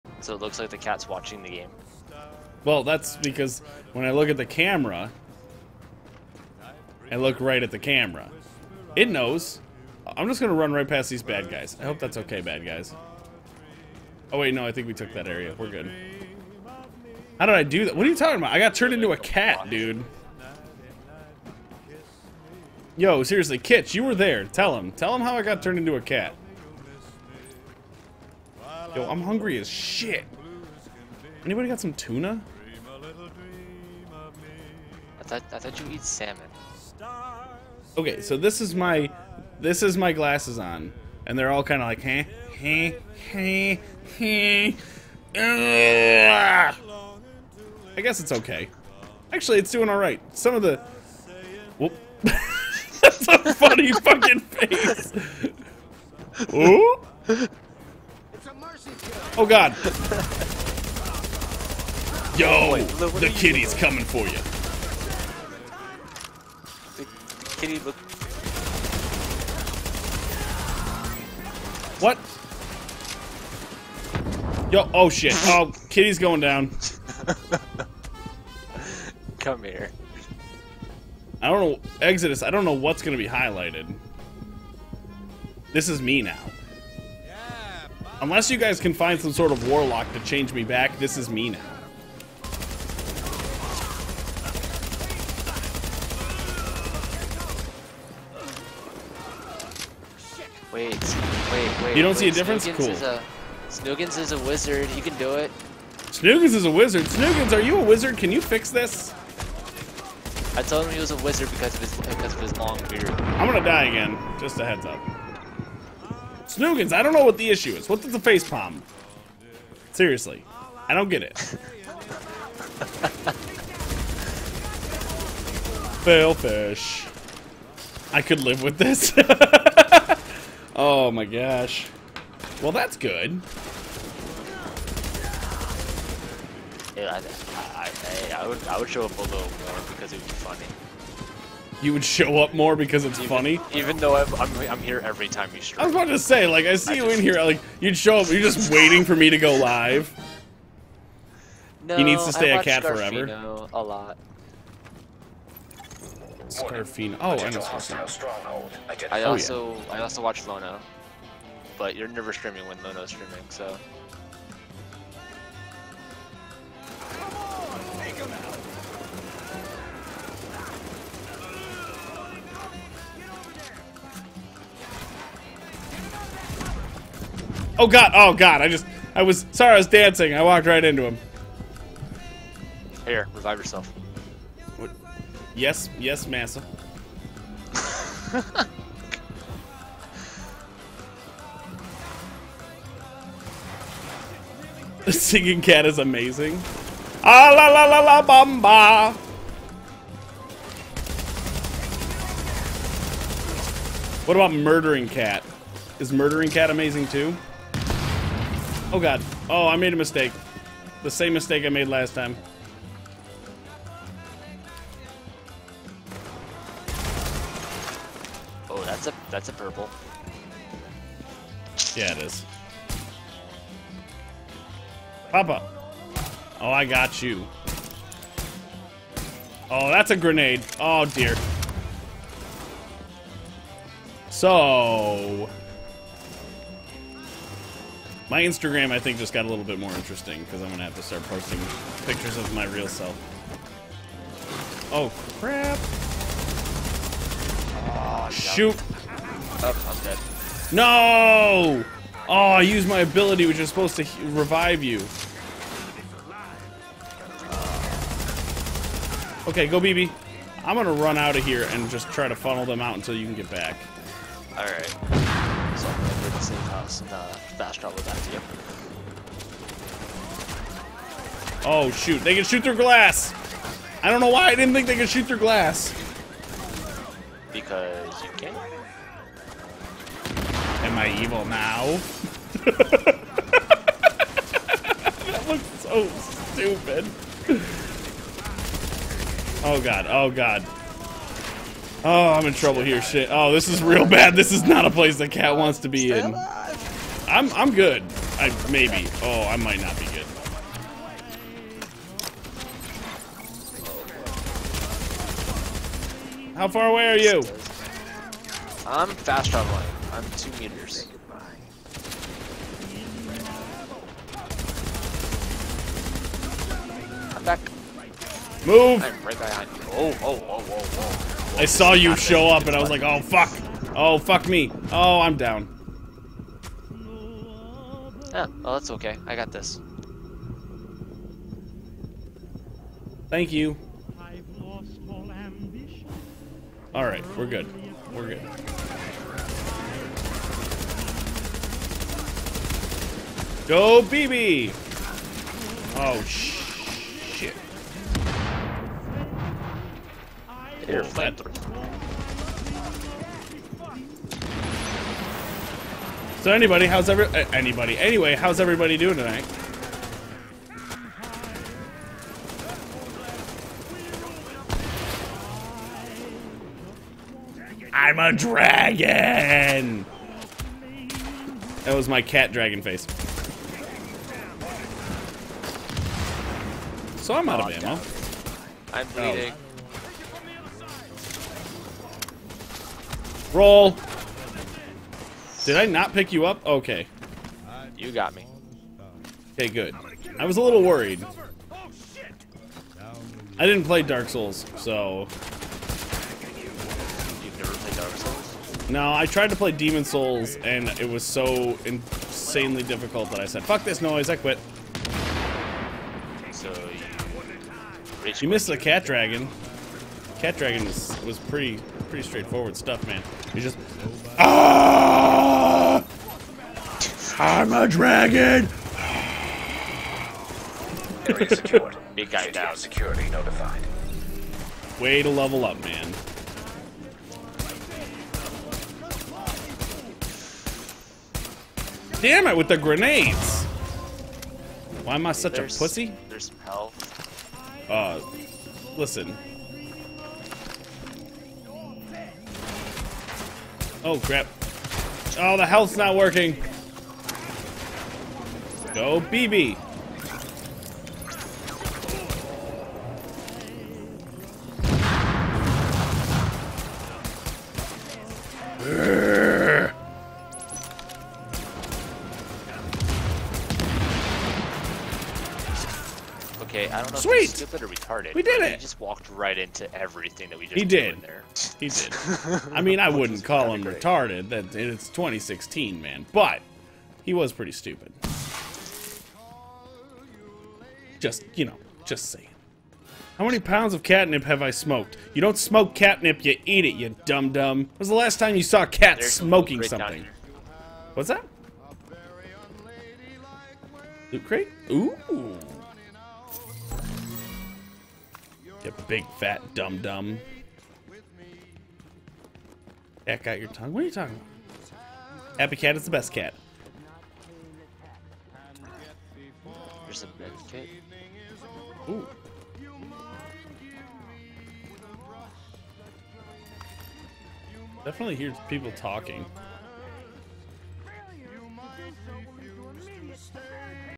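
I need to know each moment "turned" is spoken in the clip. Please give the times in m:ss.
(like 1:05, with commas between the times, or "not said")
0:18, 0:25.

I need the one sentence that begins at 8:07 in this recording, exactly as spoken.
When was the last time you saw a cat There's smoking something?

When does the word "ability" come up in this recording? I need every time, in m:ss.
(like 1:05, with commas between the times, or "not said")
4:12.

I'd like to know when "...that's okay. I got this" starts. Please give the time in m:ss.
5:28.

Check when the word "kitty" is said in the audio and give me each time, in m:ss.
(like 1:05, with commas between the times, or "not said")
1:03, 1:07, 1:15.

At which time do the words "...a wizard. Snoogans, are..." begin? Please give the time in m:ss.
1:46.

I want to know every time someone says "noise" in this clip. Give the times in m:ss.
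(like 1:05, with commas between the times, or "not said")
6:44.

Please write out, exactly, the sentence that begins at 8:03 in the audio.
How many pounds of catnip have I smoked?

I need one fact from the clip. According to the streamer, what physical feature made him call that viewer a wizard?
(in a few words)
Long beard.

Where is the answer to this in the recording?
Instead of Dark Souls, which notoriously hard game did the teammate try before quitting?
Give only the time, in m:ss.
6:39.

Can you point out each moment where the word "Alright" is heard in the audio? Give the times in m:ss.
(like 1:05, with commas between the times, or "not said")
4:24, 5:36.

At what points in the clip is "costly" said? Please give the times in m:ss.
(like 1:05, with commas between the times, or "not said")
not said.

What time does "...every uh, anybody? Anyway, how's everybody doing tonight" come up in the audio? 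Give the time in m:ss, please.
5:57.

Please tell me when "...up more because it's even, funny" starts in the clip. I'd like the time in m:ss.
2:22.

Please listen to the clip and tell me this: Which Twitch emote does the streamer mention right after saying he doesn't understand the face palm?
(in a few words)
Fail fish.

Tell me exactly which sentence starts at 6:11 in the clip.
That was my cat dragon face.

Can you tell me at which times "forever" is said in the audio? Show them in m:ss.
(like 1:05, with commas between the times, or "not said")
2:33.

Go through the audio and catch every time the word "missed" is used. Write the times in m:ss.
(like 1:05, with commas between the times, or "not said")
6:48.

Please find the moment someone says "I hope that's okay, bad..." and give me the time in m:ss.
0:11.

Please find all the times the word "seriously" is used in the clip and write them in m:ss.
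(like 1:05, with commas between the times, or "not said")
0:23, 1:59.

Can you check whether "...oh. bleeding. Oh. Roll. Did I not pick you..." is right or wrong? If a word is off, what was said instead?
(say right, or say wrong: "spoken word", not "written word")
right.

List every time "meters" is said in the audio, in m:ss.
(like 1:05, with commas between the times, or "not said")
5:10.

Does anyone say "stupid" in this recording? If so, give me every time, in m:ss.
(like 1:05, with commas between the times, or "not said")
4:46, 7:47, 7:57.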